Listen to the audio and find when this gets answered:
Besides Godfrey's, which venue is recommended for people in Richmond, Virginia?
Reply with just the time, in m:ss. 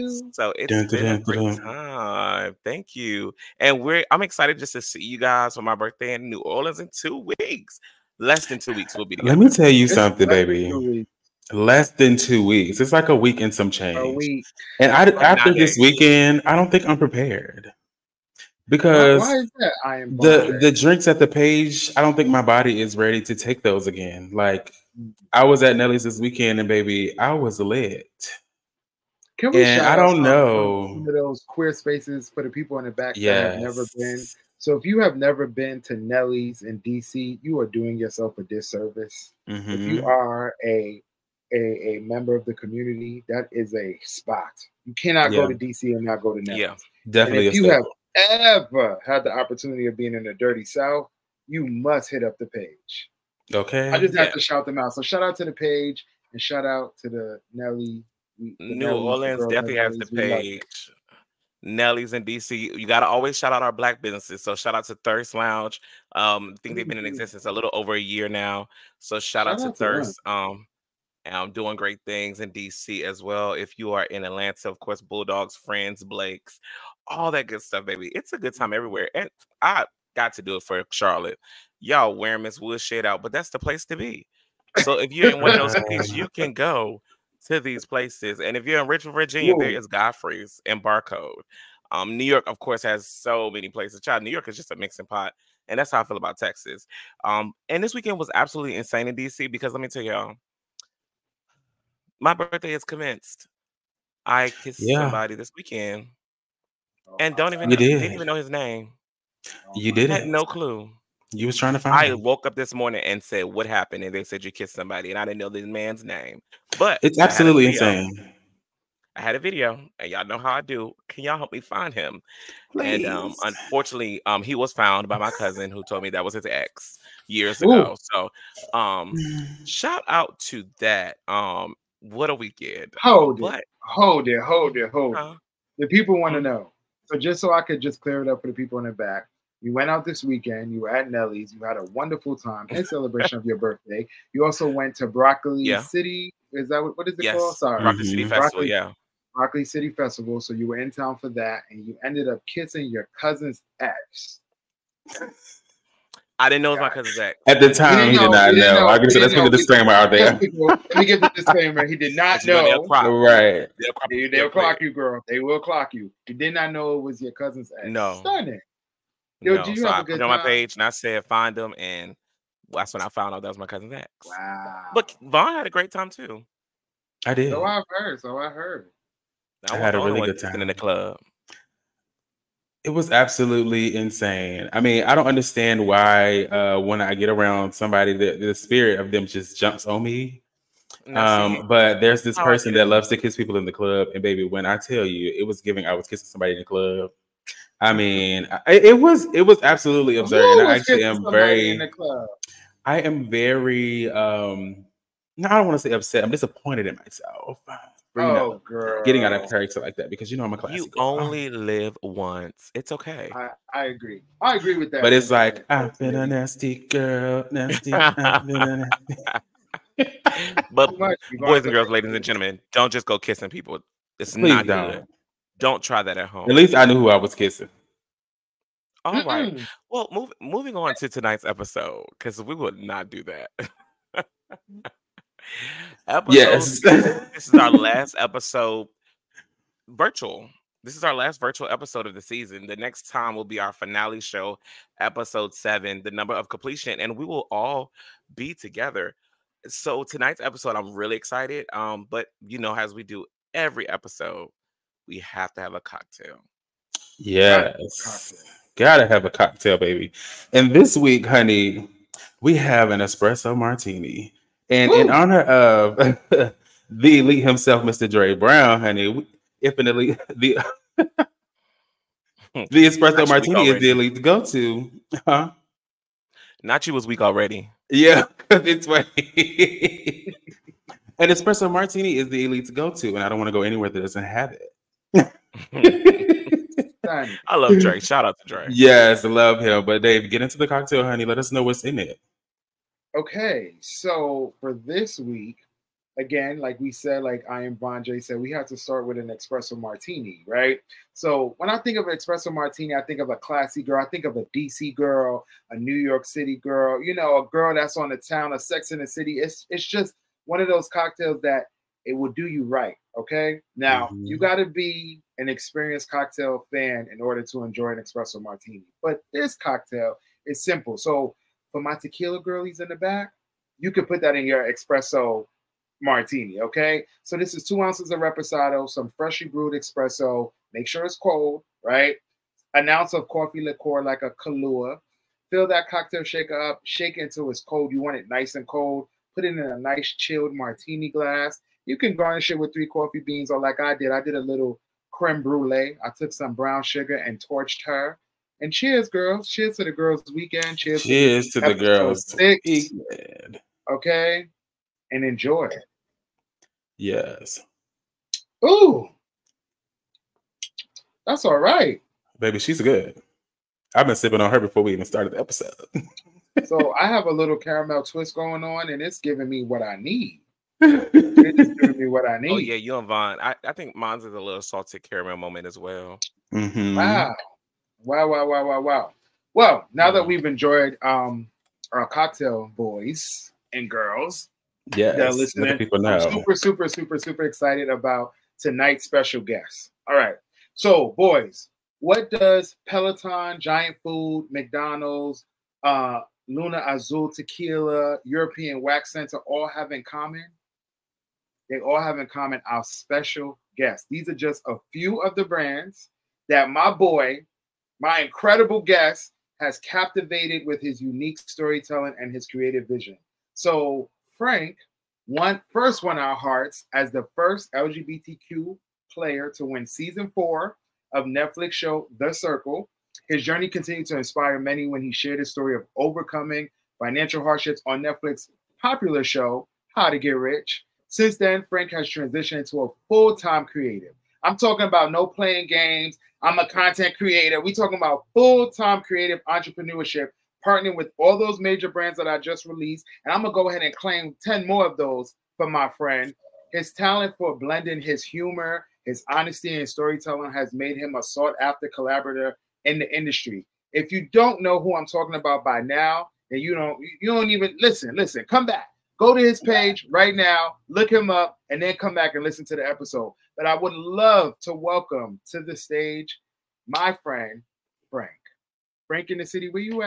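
1:30.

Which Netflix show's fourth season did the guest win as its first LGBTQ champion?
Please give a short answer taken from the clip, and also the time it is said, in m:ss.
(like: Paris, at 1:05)
The Circle, at 7:02.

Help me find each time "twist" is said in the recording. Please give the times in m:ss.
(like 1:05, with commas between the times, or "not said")
6:08.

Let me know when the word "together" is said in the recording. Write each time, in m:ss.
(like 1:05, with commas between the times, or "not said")
0:09, 4:08.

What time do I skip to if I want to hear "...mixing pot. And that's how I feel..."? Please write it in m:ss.
1:34.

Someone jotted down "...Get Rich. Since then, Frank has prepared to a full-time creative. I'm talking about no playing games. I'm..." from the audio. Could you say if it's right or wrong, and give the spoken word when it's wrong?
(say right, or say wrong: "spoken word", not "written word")
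wrong: "transitioned", not "prepared".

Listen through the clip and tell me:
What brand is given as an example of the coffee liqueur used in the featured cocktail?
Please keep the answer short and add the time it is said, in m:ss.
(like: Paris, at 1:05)
Kahlua, at 5:34.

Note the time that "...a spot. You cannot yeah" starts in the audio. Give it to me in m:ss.
0:43.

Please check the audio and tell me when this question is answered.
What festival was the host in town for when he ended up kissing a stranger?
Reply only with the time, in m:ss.
2:29.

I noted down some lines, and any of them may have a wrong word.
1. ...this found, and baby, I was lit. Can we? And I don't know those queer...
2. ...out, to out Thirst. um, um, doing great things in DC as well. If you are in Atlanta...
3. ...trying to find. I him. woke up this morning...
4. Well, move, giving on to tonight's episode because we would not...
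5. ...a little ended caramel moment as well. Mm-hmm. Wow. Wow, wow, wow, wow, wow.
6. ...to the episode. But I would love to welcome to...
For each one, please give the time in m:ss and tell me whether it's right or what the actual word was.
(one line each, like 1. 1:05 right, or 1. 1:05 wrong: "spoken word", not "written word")
1. 0:26 wrong: "weekend", not "found"
2. 1:09 right
3. 1:51 right
4. 3:49 wrong: "moving", not "giving"
5. 6:14 wrong: "salted", not "ended"
6. 7:42 right.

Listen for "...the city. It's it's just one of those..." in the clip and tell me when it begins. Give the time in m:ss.
5:08.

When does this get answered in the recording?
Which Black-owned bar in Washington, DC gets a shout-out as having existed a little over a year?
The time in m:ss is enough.
1:04.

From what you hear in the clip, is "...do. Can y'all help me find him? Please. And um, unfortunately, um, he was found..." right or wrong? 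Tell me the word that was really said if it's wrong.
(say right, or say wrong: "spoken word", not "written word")
right.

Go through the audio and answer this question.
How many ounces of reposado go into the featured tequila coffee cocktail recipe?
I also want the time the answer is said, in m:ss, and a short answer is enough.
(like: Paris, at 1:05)
2, at 5:27.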